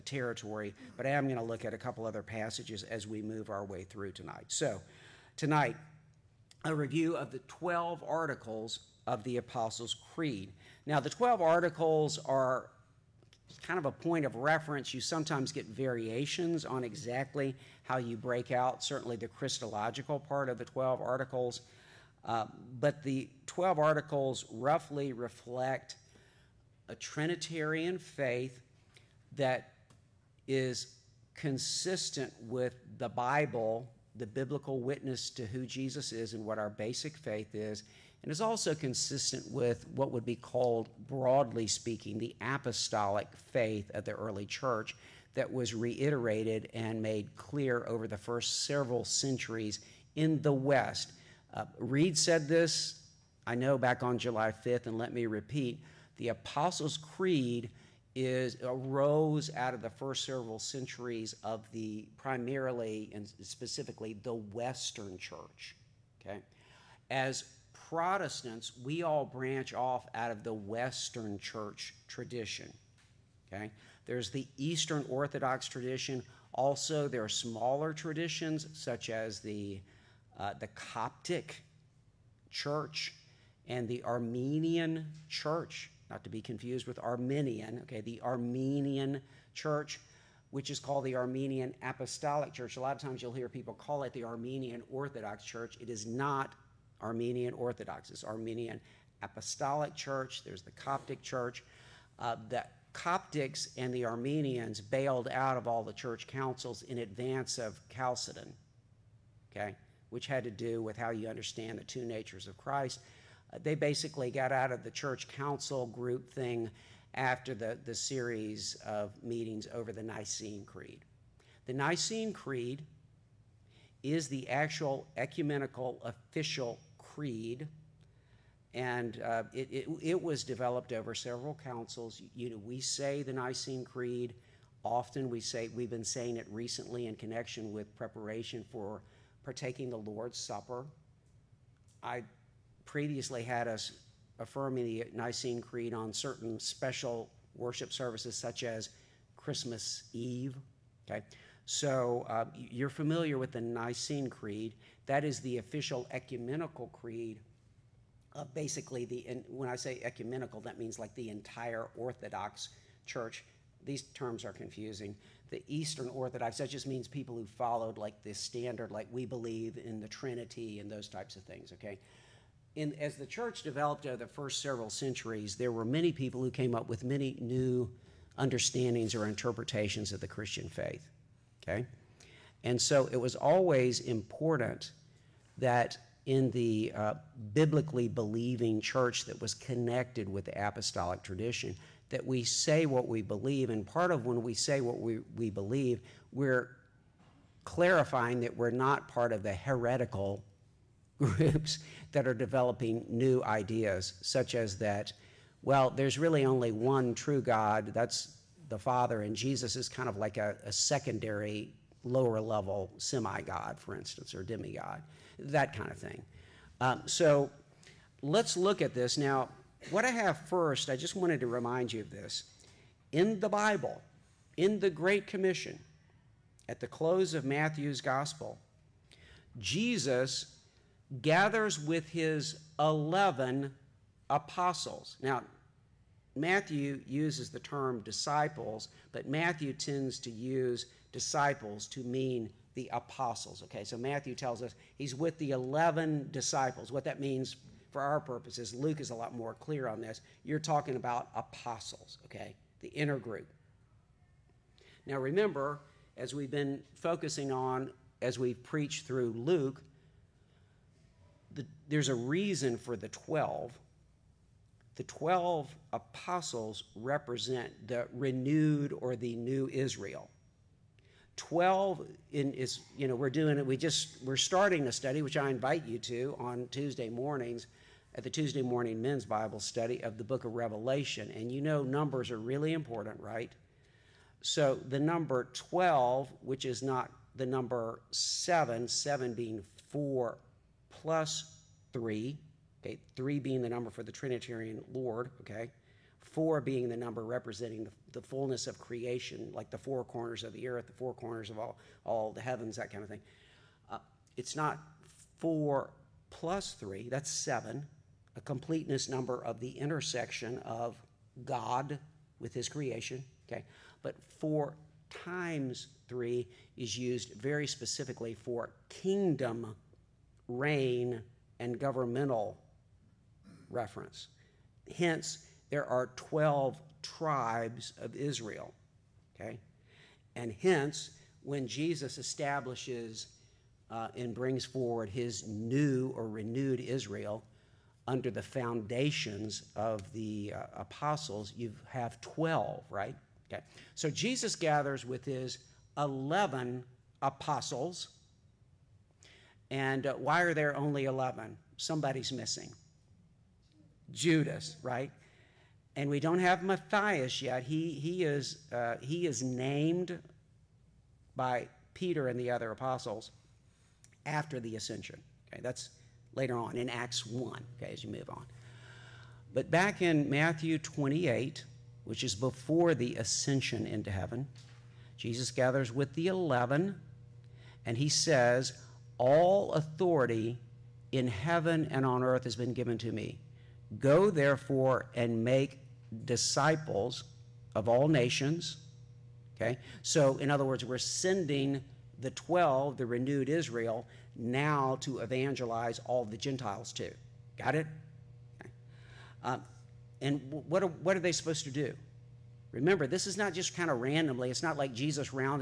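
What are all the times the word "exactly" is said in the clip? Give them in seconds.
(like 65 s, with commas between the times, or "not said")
16 s.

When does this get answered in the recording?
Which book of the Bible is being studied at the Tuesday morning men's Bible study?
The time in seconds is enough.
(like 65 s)
280 s.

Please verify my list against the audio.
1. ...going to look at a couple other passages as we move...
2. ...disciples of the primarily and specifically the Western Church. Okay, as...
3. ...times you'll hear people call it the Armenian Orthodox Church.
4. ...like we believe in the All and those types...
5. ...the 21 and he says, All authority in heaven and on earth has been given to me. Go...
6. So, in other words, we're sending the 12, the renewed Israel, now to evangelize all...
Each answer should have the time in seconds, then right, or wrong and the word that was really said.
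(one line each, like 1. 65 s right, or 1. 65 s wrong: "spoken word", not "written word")
1. 1 s right
2. 60 s wrong: "centuries", not "disciples"
3. 93 s right
4. 168 s wrong: "Trinity", not "All"
5. 376 s wrong: "11", not "21"
6. 390 s right.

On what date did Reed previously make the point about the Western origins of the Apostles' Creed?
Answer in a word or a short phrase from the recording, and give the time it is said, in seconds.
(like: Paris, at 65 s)
July 5th, at 54 s.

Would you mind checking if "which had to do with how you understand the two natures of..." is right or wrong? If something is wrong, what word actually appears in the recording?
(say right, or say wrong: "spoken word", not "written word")
right.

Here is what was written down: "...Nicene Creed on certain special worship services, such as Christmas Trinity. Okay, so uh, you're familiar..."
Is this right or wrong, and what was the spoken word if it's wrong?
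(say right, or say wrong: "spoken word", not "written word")
wrong: "Eve", not "Trinity".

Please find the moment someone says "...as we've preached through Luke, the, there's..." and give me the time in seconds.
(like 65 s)
258 s.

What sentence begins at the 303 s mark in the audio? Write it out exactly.
Uh, it's not 4 plus 3, that's 7 a completeness number of the intersection of God with his creation, okay?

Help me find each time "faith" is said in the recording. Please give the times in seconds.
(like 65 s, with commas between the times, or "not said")
27 s, 37 s, 43 s, 180 s.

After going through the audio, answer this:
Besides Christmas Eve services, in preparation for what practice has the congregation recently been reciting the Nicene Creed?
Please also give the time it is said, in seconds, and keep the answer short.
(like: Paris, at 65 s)
the Lord's Supper, at 139 s.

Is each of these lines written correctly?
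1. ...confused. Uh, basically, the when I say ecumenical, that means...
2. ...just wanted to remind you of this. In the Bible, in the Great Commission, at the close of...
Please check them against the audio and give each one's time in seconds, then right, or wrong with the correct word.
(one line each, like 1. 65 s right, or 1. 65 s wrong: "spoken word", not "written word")
1. 156 s wrong: "creed", not "confused"
2. 220 s right.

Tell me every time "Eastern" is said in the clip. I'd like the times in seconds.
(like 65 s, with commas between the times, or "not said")
74 s, 165 s.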